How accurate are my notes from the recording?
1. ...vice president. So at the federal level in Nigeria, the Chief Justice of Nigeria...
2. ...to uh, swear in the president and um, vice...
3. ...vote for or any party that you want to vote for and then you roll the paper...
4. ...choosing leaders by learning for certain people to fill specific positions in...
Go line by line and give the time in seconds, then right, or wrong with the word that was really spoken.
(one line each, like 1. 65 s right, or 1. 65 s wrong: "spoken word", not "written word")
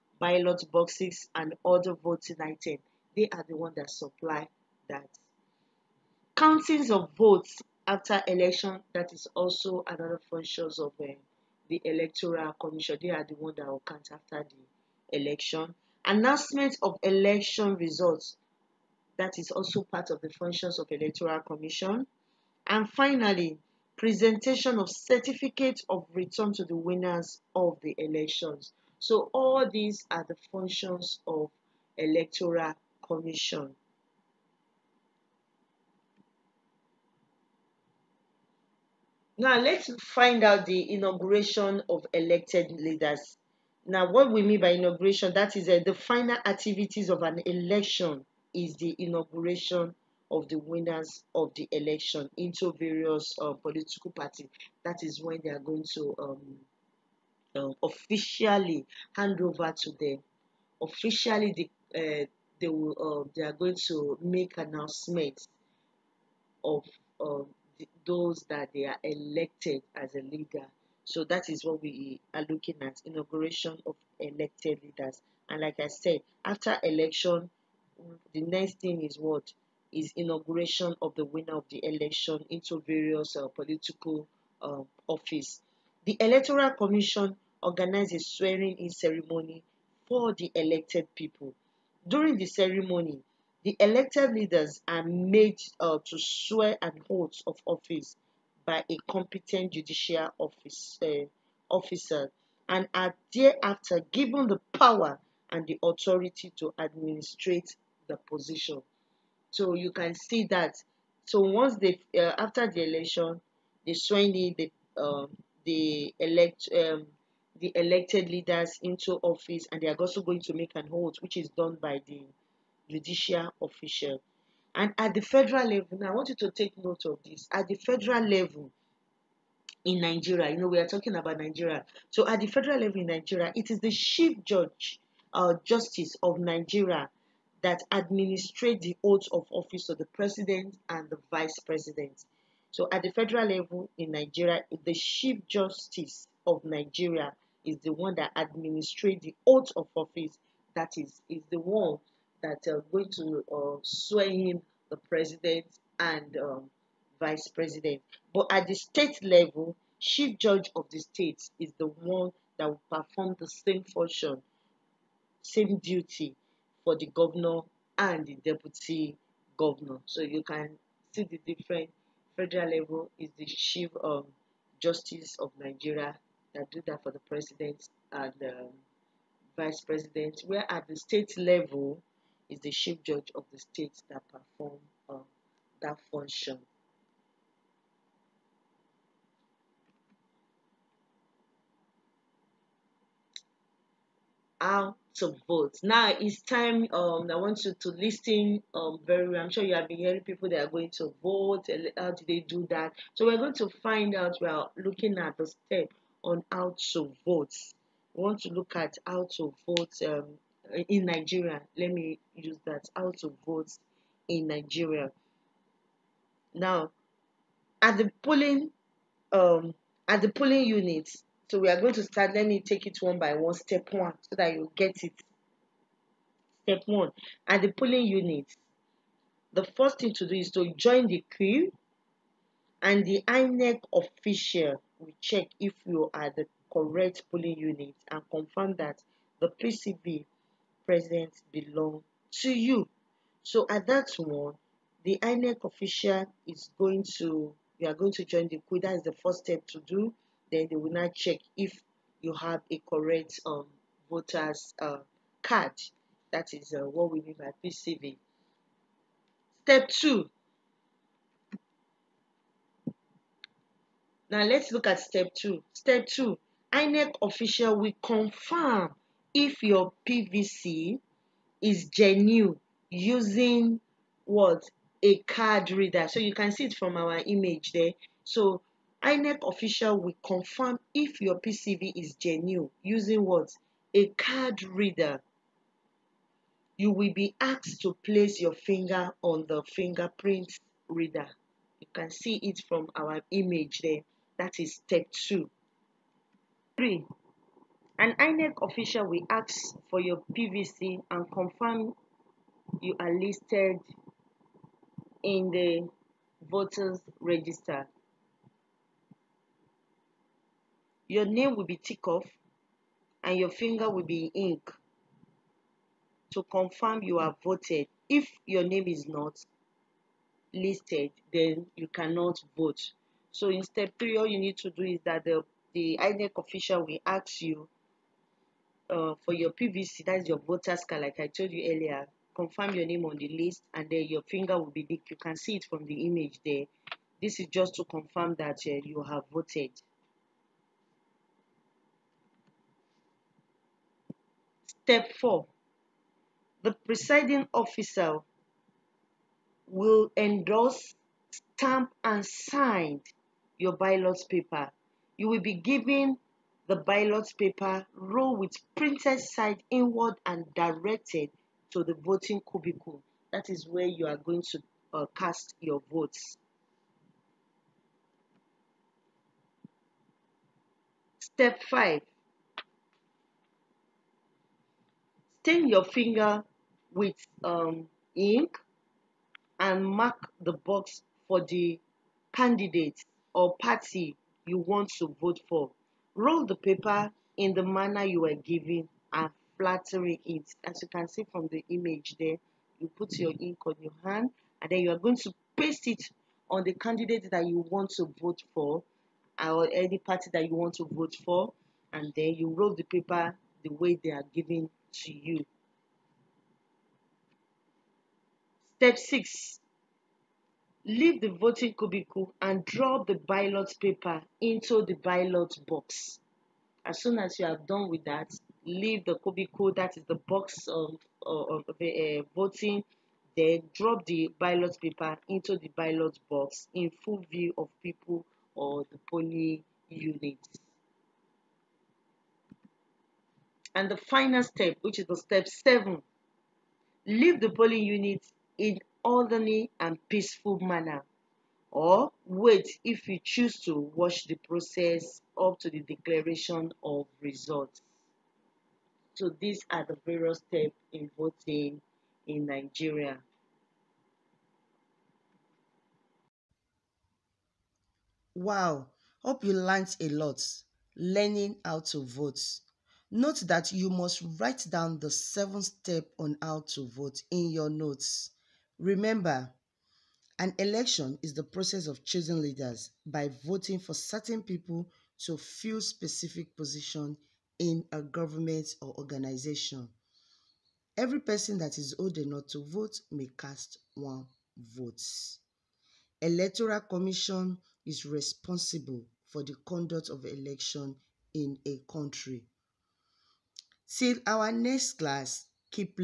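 1. 141 s right
2. 153 s right
3. 398 s right
4. 472 s wrong: "voting", not "learning".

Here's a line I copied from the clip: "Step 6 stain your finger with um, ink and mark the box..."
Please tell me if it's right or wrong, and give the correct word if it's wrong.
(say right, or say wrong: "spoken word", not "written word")
wrong: "5", not "6".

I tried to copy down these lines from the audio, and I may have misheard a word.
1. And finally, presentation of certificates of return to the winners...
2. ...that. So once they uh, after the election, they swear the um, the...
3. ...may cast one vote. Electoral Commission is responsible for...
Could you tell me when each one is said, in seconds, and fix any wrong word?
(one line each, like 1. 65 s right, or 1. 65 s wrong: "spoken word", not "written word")
1. 22 s right
2. 110 s right
3. 483 s right.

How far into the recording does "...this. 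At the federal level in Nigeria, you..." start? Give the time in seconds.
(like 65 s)
127 s.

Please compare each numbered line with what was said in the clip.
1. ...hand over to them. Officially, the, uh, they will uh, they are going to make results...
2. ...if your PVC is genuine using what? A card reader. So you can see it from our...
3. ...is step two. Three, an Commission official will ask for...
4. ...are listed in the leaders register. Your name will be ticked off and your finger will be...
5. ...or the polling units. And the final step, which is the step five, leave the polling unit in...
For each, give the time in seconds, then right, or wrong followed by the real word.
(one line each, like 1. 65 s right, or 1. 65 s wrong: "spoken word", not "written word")
1. 59 s wrong: "announcements", not "results"
2. 269 s right
3. 294 s wrong: "INEC", not "Commission"
4. 302 s wrong: "voters", not "leaders"
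5. 428 s wrong: "seven", not "five".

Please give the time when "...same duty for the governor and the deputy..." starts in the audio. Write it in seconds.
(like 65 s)
165 s.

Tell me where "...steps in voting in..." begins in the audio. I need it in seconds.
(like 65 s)
450 s.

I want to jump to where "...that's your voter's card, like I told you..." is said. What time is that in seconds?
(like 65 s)
330 s.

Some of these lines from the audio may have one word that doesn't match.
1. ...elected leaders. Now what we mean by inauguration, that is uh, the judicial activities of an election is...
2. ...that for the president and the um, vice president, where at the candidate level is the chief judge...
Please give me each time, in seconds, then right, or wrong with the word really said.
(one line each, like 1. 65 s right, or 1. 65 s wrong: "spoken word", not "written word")
1. 42 s wrong: "final", not "judicial"
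2. 176 s wrong: "state", not "candidate".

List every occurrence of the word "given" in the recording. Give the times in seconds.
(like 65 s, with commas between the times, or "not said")
104 s, 355 s, 388 s.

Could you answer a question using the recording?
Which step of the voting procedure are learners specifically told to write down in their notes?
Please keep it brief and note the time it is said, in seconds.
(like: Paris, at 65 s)
Seventh step, at 465 s.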